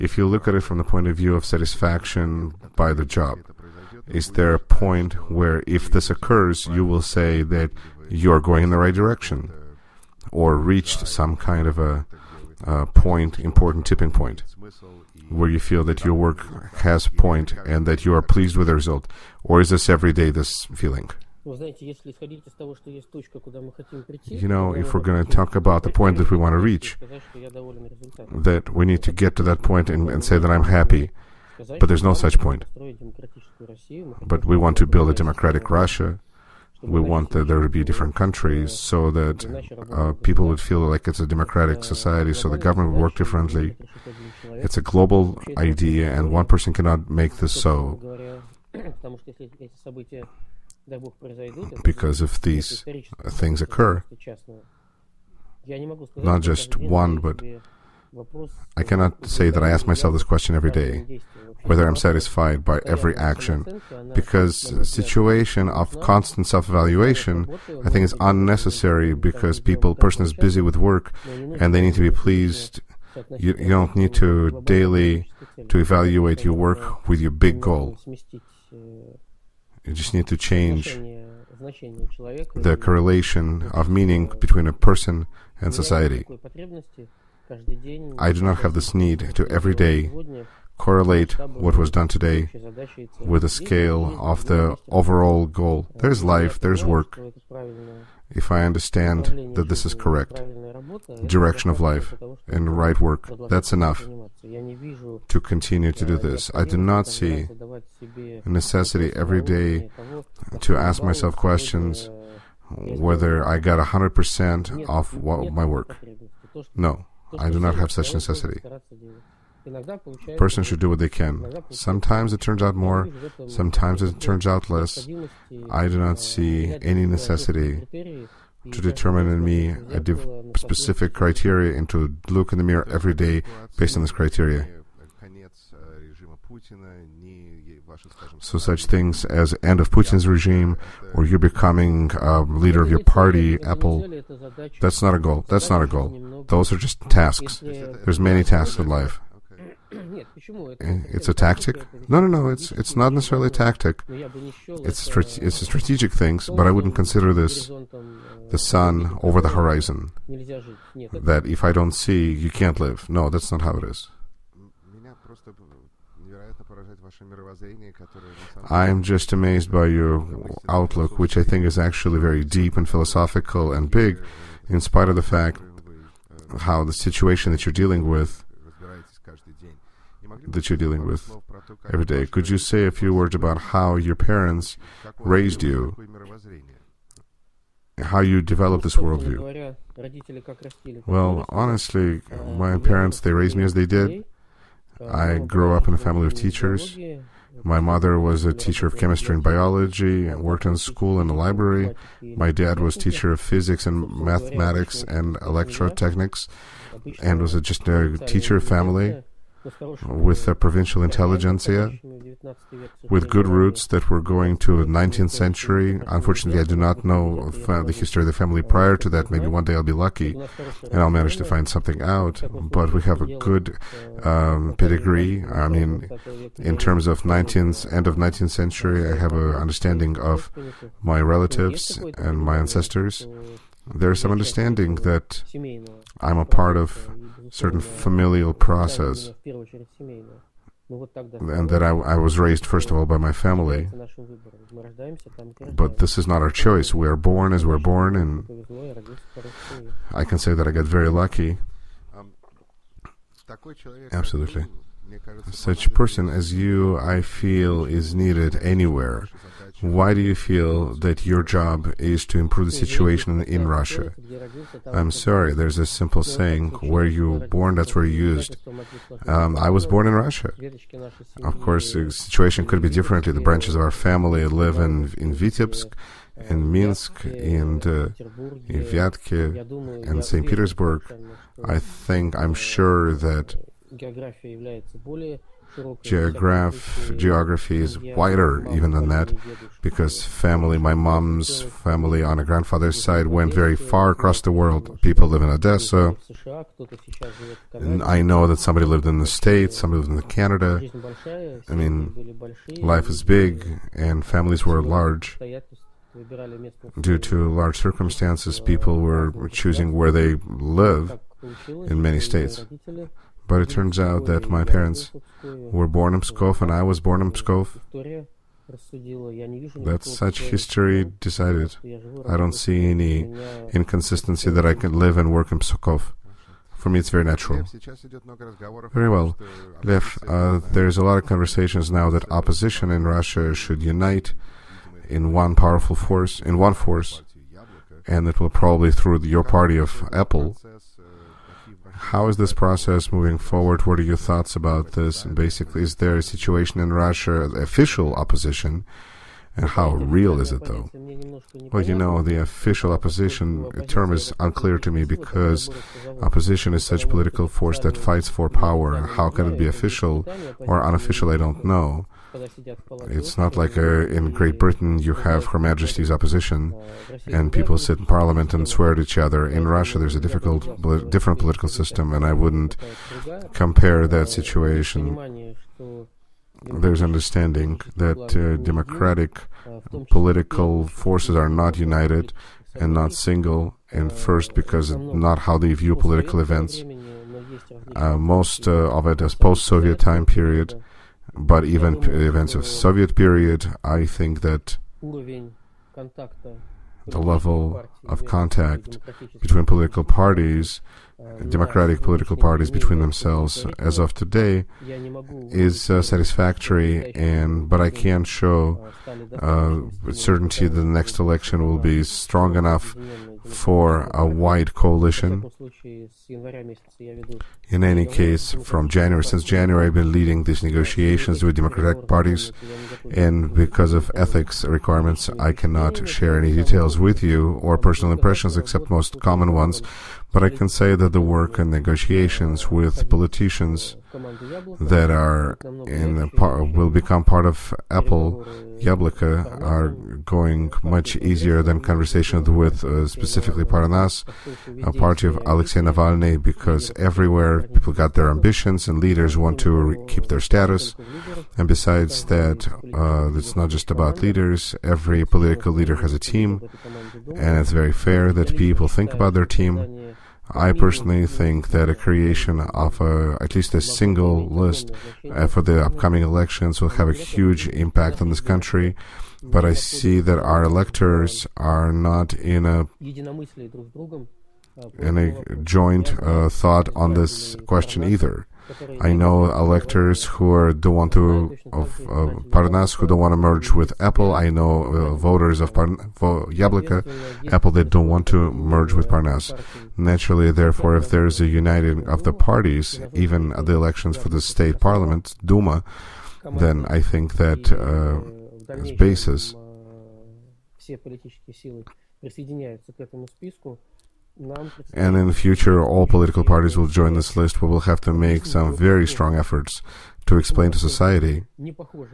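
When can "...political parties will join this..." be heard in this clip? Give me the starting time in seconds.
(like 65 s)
506 s.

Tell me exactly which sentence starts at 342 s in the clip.
How is this process moving forward?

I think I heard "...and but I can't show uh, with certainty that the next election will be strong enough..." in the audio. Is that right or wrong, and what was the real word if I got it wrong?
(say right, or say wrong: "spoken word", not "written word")
right.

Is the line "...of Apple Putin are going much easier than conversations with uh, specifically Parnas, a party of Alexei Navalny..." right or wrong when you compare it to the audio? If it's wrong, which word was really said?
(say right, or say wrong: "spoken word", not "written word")
wrong: "Yabloko", not "Putin".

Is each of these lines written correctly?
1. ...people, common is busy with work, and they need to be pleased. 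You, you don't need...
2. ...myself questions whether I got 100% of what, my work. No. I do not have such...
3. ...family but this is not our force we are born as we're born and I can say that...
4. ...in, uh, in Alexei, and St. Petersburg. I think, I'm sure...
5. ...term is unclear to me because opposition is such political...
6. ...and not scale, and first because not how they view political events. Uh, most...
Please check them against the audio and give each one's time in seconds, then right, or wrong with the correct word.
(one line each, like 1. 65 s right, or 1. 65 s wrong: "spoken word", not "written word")
1. 69 s wrong: "person", not "common"
2. 111 s right
3. 243 s wrong: "choice", not "force"
4. 277 s wrong: "Vyatke", not "Alexei"
5. 353 s right
6. 382 s wrong: "single", not "scale".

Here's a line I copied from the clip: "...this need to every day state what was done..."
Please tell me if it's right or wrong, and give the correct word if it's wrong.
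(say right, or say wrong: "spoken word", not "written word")
wrong: "correlate", not "state".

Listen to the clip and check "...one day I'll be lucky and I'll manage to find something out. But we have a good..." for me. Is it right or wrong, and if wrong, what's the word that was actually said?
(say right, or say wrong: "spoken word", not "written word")
right.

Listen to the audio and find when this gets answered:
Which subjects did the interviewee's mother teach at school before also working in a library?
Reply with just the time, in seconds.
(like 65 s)
198 s.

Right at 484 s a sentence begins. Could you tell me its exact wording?
I know uh, voters of Parn- vo- Apple that don't want to merge with Parnas.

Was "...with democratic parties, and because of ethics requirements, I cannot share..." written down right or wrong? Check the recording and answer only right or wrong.
right.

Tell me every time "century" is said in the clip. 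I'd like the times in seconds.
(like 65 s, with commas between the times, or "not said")
215 s, 228 s.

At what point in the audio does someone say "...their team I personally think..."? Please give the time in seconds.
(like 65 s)
459 s.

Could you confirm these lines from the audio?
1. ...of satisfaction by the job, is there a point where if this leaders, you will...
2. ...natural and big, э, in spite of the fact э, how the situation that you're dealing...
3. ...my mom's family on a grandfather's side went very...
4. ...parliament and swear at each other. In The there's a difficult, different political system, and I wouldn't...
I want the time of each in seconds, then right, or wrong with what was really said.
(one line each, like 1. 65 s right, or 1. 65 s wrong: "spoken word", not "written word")
1. 1 s wrong: "occurs", not "leaders"
2. 172 s wrong: "philosophical", not "natural"
3. 290 s right
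4. 368 s wrong: "Russia", not "The".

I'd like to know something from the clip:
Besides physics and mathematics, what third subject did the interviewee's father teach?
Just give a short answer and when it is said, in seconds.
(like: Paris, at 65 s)
Electrotechnics, at 205 s.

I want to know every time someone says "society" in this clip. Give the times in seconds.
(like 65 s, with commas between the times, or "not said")
41 s, 85 s, 510 s.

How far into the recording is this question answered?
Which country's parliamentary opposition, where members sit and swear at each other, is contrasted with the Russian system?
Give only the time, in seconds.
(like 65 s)
364 s.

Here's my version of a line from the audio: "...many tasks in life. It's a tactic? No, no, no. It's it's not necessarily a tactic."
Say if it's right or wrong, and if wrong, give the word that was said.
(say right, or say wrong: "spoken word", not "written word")
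right.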